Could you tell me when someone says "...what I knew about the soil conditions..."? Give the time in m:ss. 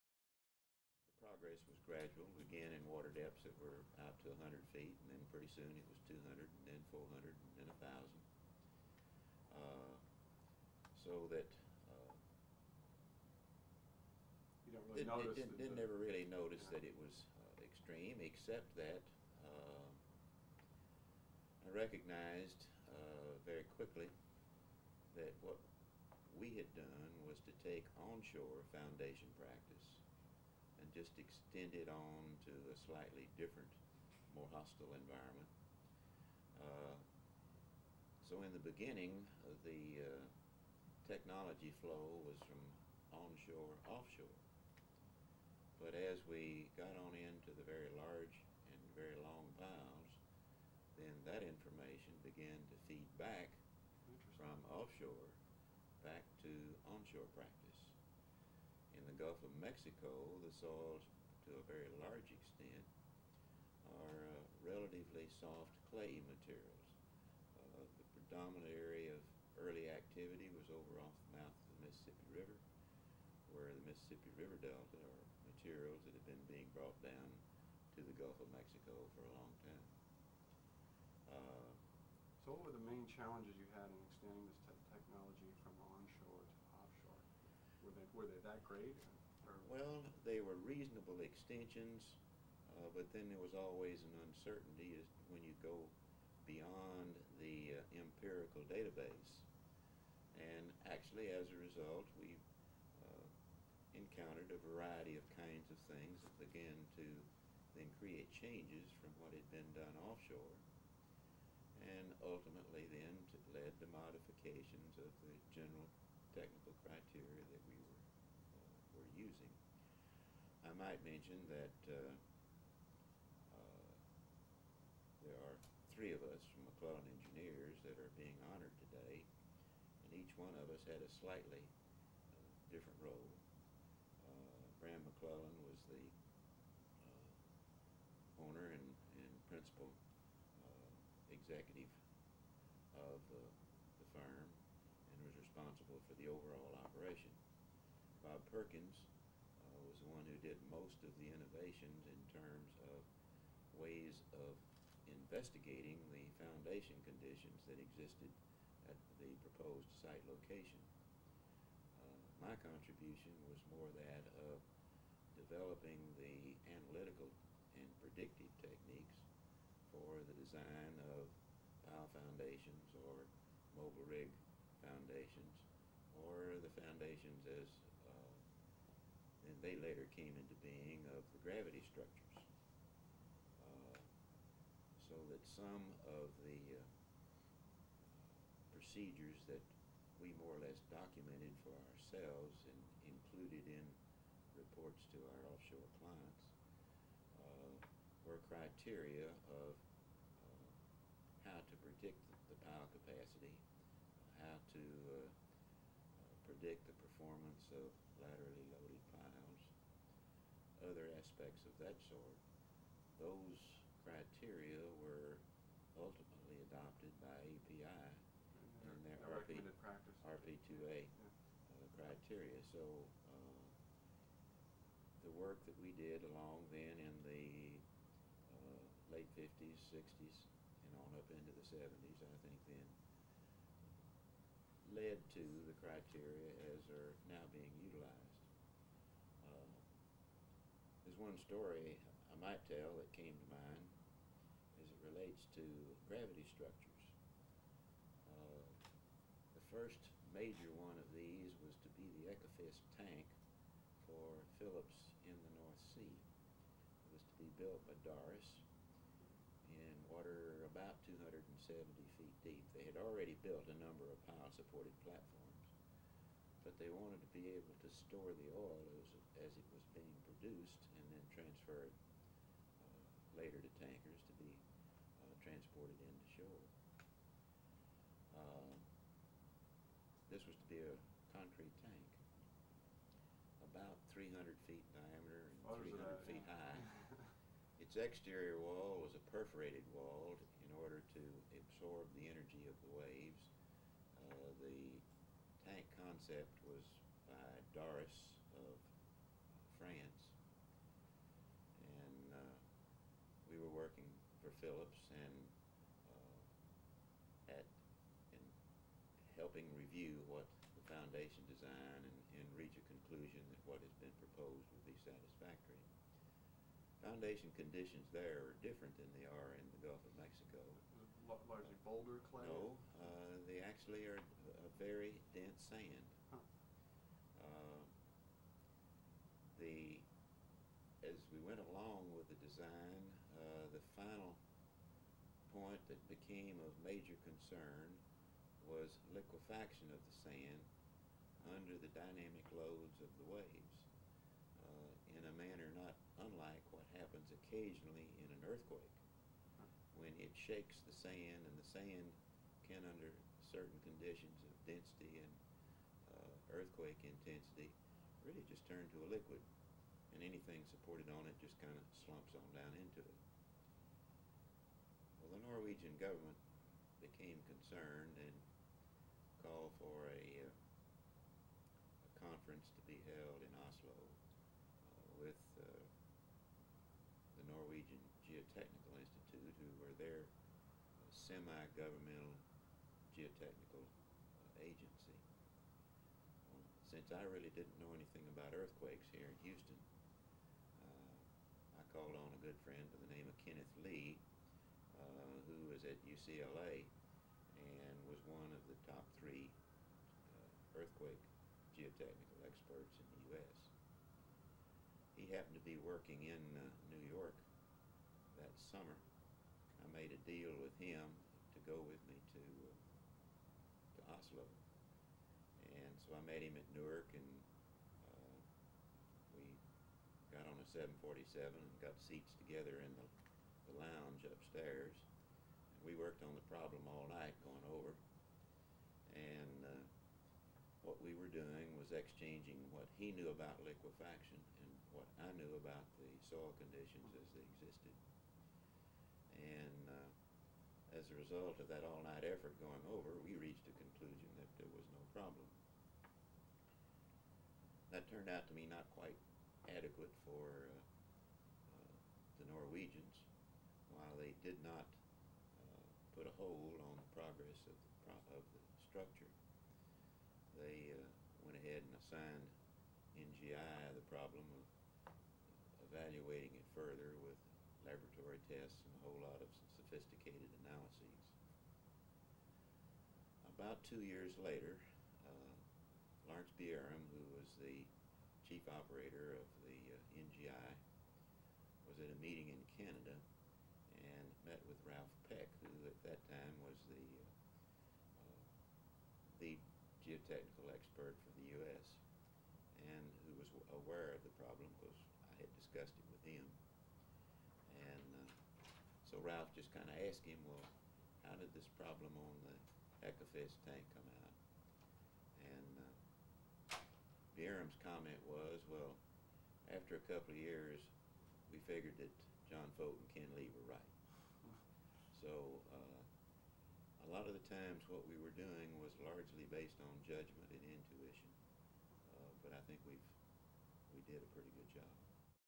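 7:14.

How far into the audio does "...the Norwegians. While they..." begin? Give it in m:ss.
7:32.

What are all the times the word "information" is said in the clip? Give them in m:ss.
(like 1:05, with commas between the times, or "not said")
0:51.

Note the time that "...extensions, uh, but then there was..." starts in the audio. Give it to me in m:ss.
1:31.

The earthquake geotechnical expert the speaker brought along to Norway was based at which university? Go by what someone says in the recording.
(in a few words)
UCLA.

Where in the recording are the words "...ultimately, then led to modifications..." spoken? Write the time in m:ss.
1:52.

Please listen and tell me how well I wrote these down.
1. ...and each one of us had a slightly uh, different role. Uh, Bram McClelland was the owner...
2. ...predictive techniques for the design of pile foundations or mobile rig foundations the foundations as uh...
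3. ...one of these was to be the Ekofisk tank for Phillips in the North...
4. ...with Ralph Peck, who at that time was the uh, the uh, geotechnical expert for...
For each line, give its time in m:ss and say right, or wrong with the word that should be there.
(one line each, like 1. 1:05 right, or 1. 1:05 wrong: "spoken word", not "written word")
1. 2:10 right
2. 2:48 right
3. 4:10 right
4. 8:04 right.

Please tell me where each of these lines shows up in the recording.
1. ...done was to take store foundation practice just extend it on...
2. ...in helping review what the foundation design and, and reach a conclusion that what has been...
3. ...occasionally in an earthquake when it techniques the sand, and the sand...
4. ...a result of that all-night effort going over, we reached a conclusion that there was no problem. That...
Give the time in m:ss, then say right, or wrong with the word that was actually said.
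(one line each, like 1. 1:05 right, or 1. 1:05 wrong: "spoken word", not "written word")
1. 0:26 wrong: "onshore", not "store"
2. 5:08 right
3. 5:47 wrong: "shakes", not "techniques"
4. 7:21 right.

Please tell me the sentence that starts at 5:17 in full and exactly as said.
Foundation conditions there are different than they are in the Gulf of Mexico largely boulder clay?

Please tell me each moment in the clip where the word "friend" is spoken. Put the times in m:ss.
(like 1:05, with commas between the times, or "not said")
6:32.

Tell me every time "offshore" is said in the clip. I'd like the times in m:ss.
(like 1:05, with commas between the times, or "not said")
0:43, 0:54, 1:50, 3:15.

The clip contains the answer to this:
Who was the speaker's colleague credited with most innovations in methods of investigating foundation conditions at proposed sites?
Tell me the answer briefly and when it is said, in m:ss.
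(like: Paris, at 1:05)
Bob Perkins, at 2:28.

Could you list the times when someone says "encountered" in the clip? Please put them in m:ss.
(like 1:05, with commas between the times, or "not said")
1:43.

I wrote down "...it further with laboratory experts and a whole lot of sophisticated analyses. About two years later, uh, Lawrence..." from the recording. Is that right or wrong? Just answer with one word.
wrong.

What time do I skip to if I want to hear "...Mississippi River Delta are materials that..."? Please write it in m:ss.
1:13.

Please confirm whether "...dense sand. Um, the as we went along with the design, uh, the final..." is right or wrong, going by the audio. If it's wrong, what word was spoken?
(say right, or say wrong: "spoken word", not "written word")
right.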